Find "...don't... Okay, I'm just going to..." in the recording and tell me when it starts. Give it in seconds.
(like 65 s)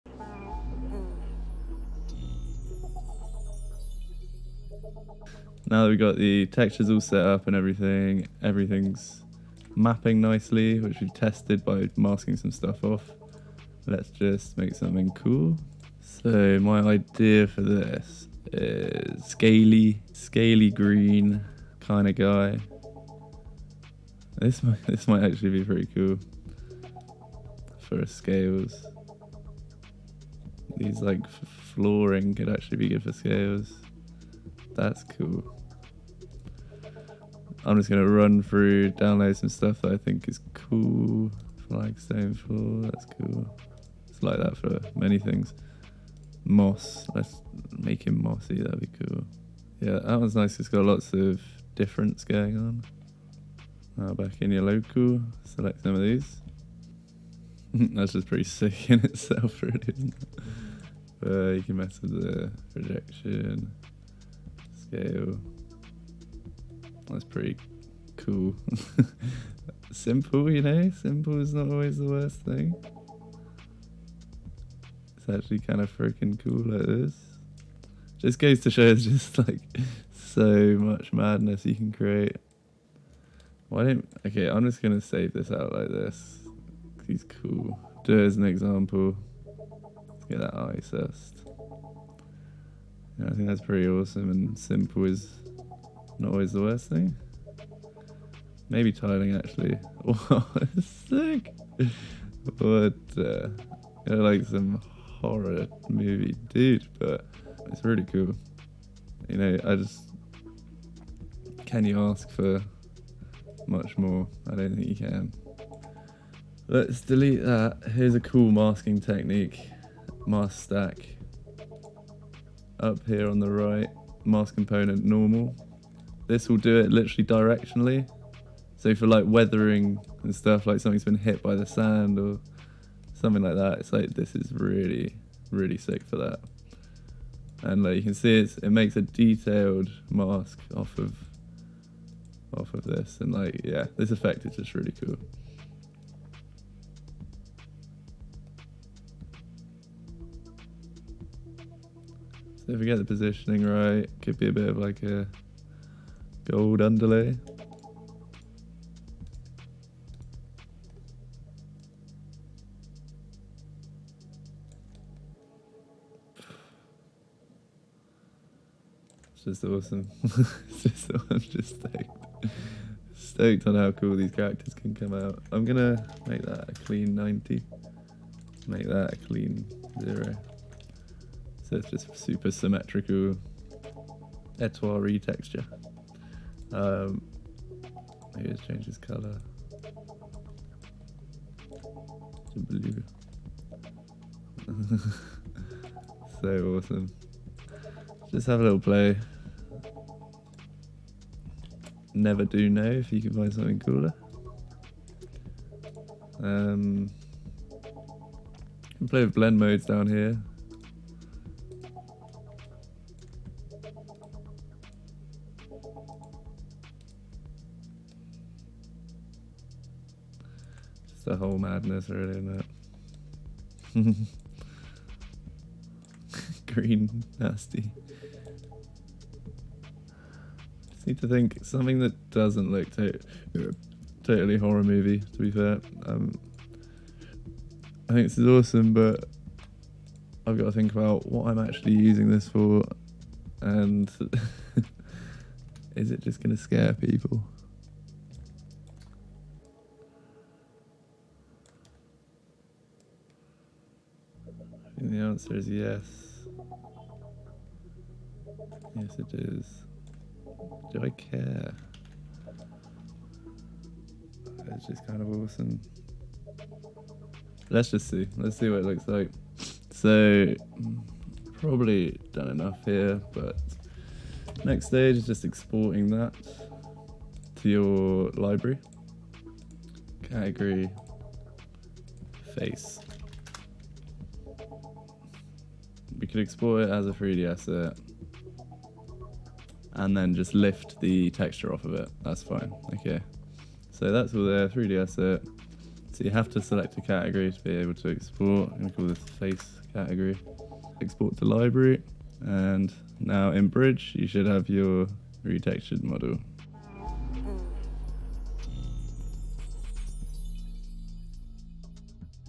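83 s.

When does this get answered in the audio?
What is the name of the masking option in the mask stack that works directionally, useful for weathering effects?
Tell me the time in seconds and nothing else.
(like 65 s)
124 s.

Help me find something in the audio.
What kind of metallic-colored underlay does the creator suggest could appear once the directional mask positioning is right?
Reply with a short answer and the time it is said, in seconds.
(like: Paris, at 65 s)
Gold, at 156 s.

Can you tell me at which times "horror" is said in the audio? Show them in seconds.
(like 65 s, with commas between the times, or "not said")
105 s, 234 s.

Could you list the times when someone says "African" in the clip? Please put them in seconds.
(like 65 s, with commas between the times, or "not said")
not said.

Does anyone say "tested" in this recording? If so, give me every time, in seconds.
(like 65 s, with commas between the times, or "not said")
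11 s.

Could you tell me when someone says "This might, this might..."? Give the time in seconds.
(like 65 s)
24 s.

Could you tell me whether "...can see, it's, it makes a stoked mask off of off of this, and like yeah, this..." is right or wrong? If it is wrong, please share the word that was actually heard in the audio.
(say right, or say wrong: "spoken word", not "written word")
wrong: "detailed", not "stoked".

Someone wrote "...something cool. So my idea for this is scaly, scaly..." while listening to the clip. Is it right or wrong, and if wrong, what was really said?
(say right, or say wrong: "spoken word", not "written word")
right.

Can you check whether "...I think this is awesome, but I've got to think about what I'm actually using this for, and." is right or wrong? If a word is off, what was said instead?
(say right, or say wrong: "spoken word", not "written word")
right.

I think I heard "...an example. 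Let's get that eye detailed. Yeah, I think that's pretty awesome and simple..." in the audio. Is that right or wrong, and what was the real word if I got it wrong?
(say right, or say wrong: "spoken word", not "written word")
wrong: "assessed", not "detailed".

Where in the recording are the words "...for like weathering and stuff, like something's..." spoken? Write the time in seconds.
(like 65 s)
128 s.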